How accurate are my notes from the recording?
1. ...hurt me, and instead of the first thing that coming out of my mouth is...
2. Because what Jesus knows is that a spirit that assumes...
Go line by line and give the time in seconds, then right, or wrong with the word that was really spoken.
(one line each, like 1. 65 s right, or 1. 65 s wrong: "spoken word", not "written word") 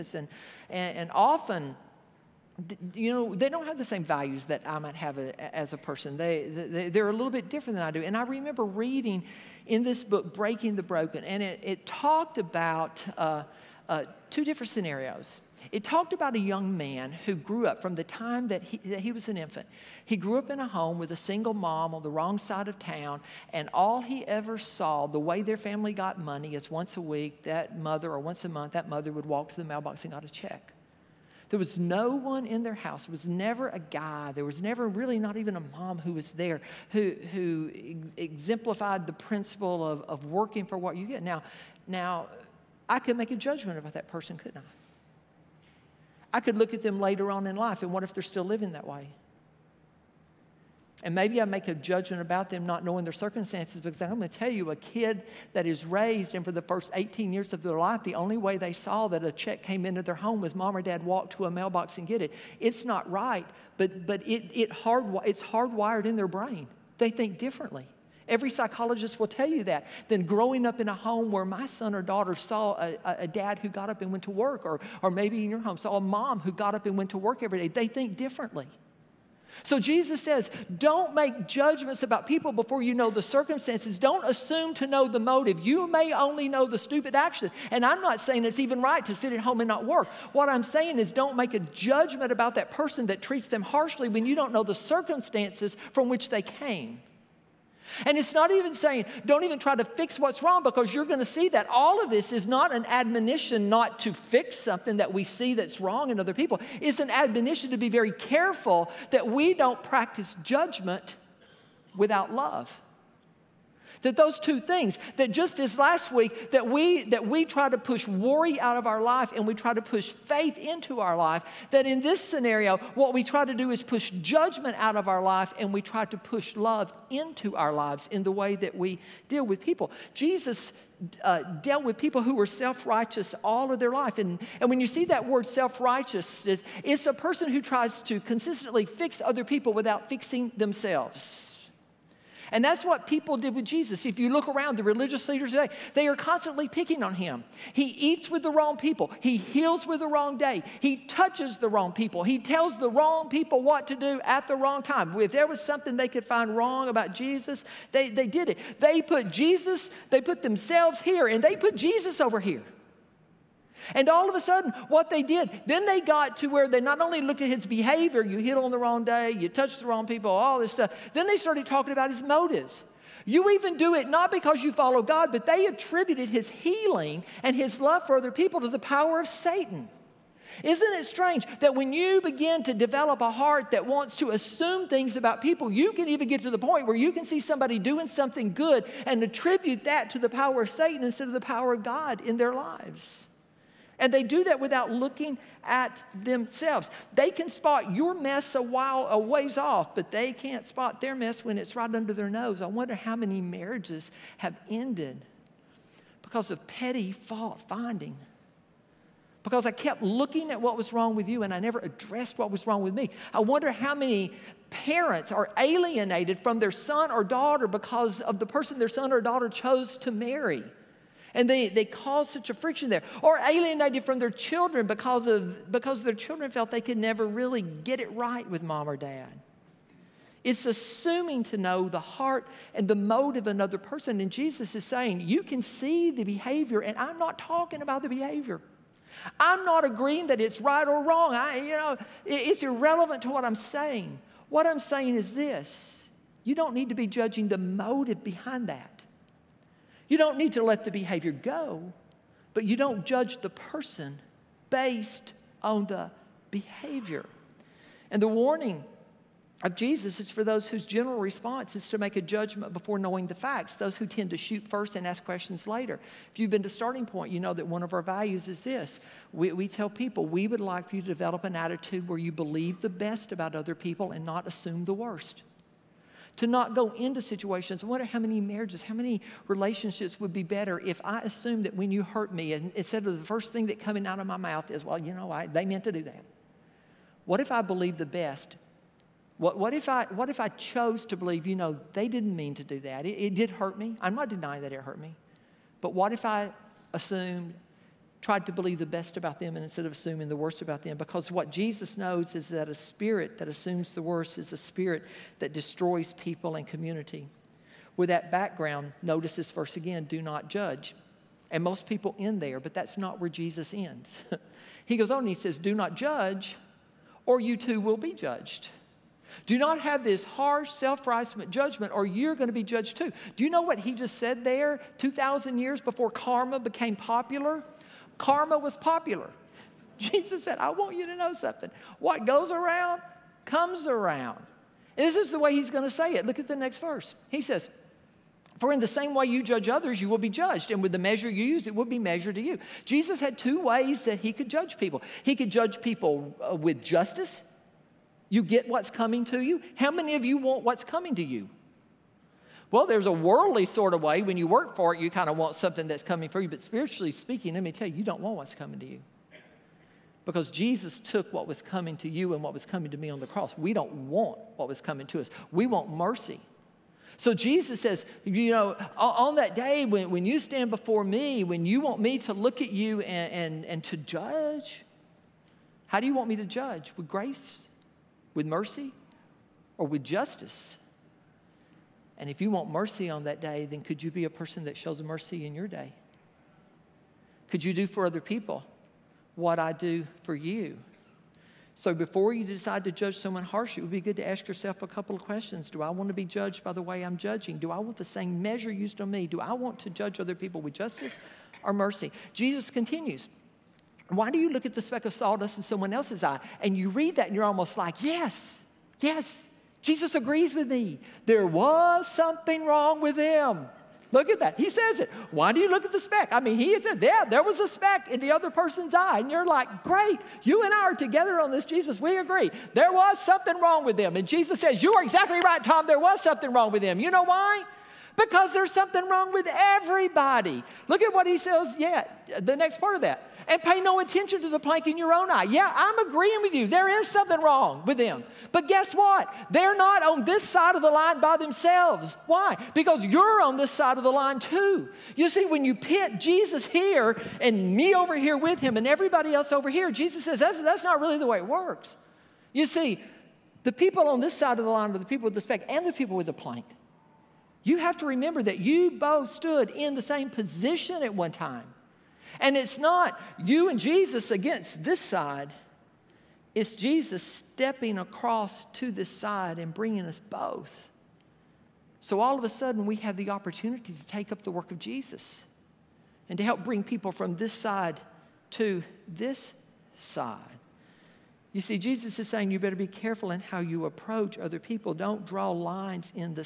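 1. 282 s right
2. 300 s right.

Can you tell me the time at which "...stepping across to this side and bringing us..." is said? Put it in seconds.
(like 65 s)
467 s.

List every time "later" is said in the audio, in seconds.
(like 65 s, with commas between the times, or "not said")
46 s, 265 s.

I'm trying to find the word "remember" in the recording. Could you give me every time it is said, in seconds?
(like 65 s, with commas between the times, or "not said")
8 s, 458 s.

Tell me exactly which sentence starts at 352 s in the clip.
Well, there's a worldly sort of way.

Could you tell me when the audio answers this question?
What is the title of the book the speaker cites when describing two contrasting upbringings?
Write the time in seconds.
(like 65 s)
10 s.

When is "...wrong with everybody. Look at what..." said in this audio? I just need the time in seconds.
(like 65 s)
429 s.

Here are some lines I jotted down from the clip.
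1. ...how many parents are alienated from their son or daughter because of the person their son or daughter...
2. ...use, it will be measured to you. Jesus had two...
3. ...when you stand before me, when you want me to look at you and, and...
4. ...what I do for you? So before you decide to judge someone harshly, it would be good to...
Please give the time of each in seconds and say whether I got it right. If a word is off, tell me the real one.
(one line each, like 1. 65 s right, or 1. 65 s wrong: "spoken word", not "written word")
1. 213 s right
2. 341 s right
3. 370 s right
4. 389 s right.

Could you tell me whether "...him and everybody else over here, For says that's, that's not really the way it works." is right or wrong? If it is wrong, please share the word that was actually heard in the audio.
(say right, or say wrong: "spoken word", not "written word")
wrong: "Jesus", not "For".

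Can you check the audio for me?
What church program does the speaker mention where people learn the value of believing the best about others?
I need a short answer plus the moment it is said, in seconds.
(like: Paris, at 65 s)
Starting Point, at 266 s.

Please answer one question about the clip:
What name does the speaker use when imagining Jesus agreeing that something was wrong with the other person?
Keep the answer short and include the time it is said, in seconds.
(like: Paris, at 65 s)
Tom, at 425 s.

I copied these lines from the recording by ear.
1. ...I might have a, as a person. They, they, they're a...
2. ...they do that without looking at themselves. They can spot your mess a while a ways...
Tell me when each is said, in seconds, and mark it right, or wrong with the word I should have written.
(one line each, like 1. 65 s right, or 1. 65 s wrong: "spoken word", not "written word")
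1. 4 s right
2. 194 s right.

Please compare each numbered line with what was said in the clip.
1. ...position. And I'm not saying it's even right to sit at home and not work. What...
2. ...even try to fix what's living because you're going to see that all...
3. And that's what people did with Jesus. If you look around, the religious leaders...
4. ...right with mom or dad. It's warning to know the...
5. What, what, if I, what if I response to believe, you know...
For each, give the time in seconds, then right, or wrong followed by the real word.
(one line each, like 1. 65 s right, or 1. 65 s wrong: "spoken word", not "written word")
1. 87 s wrong: "action", not "position"
2. 99 s wrong: "wrong", not "living"
3. 142 s right
4. 228 s wrong: "assuming", not "warning"
5. 289 s wrong: "chose", not "response".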